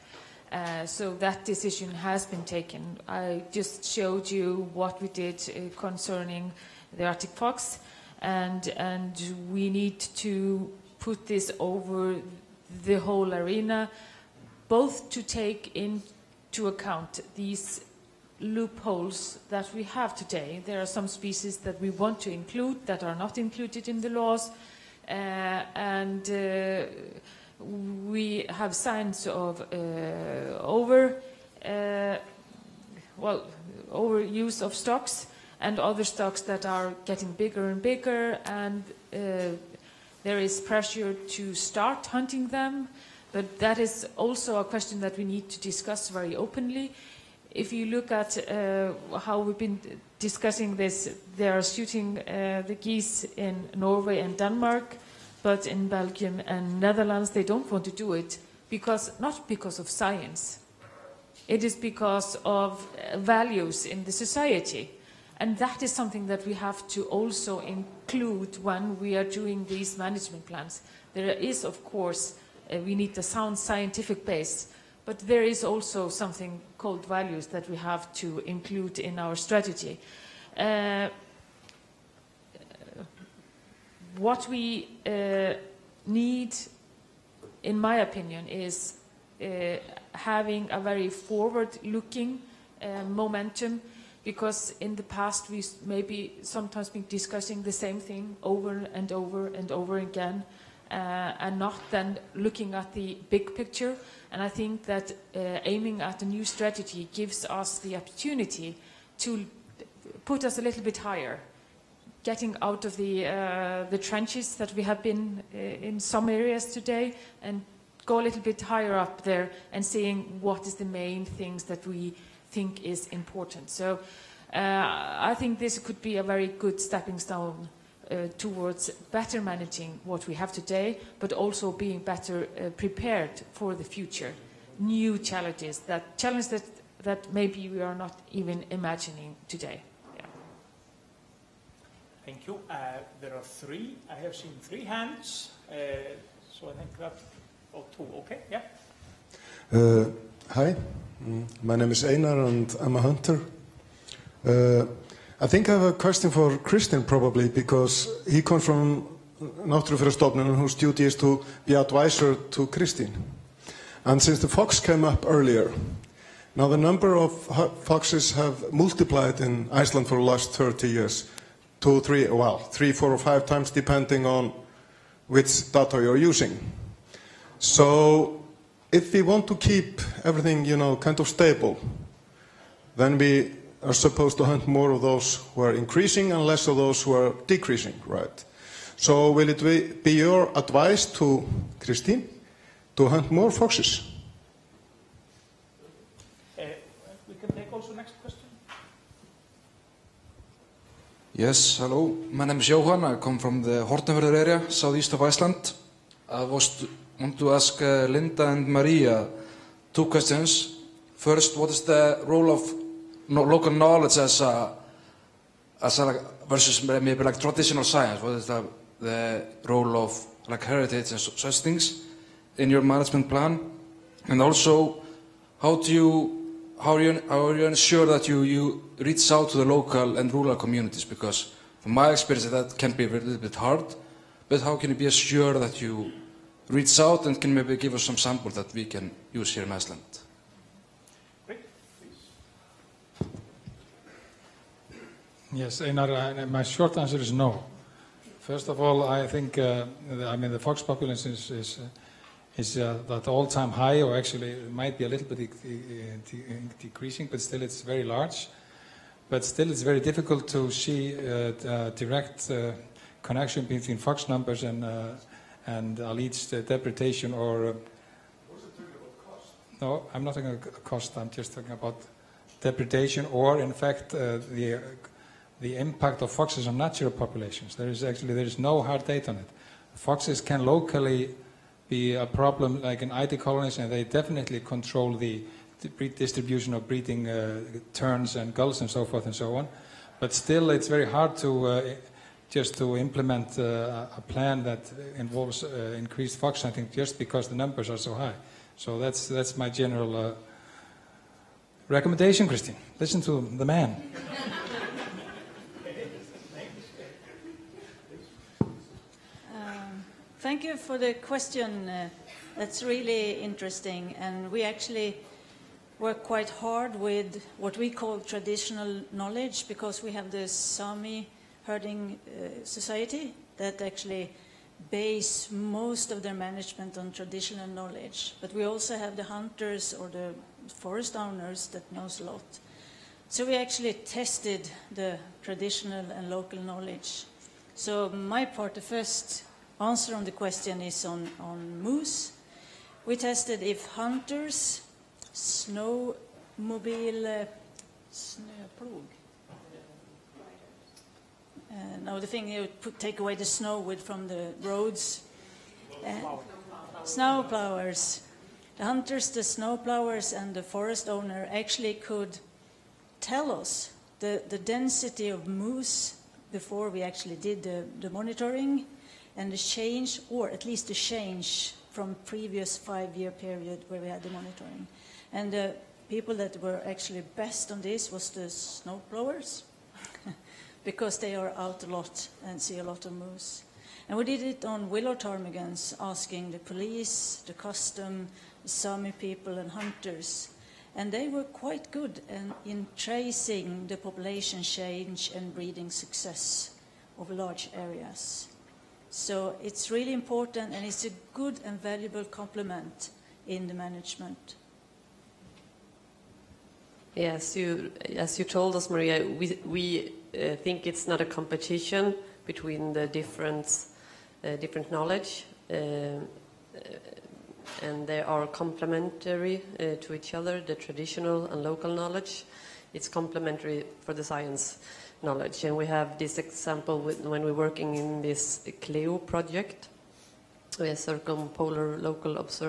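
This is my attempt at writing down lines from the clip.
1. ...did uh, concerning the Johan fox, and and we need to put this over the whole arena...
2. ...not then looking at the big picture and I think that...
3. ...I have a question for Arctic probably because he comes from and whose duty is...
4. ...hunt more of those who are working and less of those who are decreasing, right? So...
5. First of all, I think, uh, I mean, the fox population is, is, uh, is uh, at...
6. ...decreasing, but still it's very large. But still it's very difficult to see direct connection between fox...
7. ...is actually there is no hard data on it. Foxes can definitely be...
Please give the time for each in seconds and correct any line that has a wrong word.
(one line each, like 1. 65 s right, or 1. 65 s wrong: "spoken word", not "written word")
1. 5 s wrong: "Arctic", not "Johan"
2. 101 s right
3. 155 s wrong: "Kristinn", not "Arctic"
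4. 184 s wrong: "increasing", not "working"
5. 248 s right
6. 256 s right
7. 277 s wrong: "locally", not "definitely".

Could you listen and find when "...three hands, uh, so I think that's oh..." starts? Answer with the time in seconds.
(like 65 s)
144 s.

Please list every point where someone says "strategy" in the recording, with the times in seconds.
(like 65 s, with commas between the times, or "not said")
79 s, 106 s.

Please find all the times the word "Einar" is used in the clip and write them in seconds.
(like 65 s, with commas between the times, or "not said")
152 s, 245 s.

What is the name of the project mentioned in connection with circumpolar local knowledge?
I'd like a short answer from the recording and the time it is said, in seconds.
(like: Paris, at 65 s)
CLEO, at 428 s.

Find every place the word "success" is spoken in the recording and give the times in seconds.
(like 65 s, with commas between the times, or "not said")
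395 s.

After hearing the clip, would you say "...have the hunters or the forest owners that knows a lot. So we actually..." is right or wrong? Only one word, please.
right.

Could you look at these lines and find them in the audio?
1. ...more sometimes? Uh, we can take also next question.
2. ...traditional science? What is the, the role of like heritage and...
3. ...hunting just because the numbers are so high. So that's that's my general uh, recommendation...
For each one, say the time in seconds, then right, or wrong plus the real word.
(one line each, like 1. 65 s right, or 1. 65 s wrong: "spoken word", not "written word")
1. 193 s wrong: "foxes", not "sometimes"
2. 217 s right
3. 296 s right.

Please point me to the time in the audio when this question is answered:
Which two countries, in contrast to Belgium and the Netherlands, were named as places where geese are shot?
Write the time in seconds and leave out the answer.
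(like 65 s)
53 s.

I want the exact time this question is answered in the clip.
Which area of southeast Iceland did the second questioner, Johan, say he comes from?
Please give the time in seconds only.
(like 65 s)
203 s.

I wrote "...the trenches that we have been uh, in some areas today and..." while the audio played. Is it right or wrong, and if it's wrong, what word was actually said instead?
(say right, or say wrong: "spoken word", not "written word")
right.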